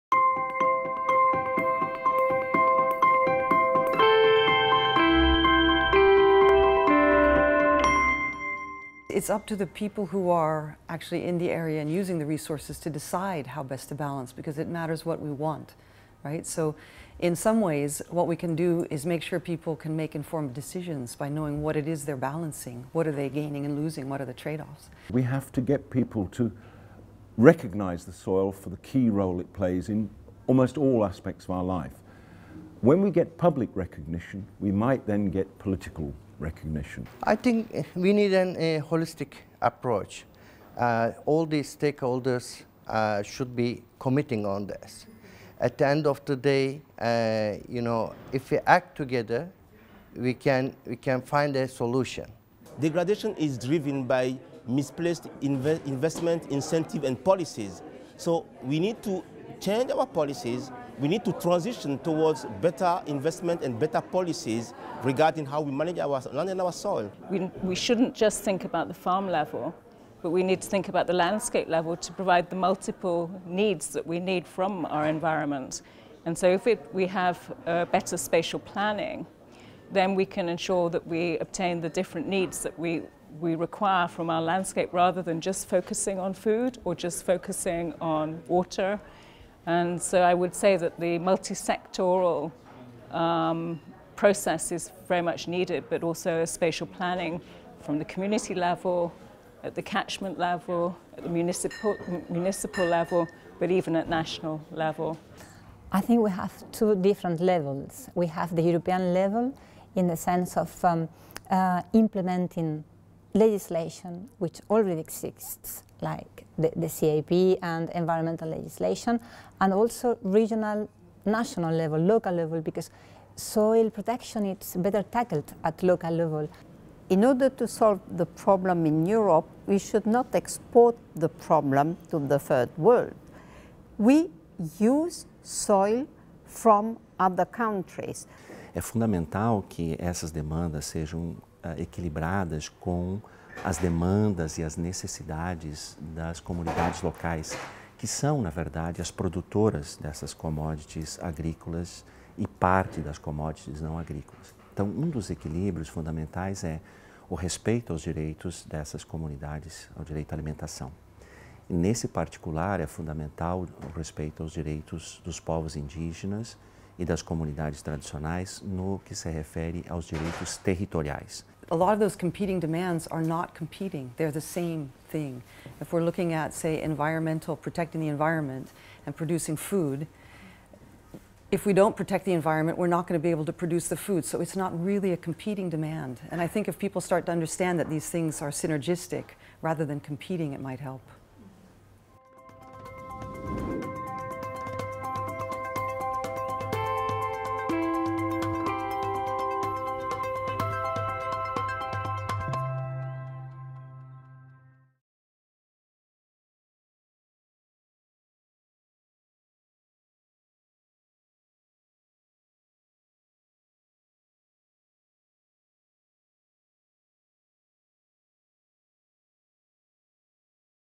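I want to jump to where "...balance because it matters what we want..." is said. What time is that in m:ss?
0:13.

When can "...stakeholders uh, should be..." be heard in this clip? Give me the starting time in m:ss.
0:41.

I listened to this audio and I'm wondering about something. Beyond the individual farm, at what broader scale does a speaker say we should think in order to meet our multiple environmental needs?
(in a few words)
Landscape level.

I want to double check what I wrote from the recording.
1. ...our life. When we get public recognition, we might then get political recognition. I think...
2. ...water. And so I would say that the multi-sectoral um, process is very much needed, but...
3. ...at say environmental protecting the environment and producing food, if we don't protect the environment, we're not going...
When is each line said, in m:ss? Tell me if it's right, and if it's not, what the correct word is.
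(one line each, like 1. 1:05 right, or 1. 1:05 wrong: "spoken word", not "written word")
1. 0:31 right
2. 1:28 right
3. 2:56 right.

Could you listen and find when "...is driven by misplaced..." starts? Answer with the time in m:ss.
0:53.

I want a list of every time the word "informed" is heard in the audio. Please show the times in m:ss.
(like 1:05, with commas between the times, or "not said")
0:20.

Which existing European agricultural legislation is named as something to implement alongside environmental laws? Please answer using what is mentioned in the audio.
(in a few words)
The CAP.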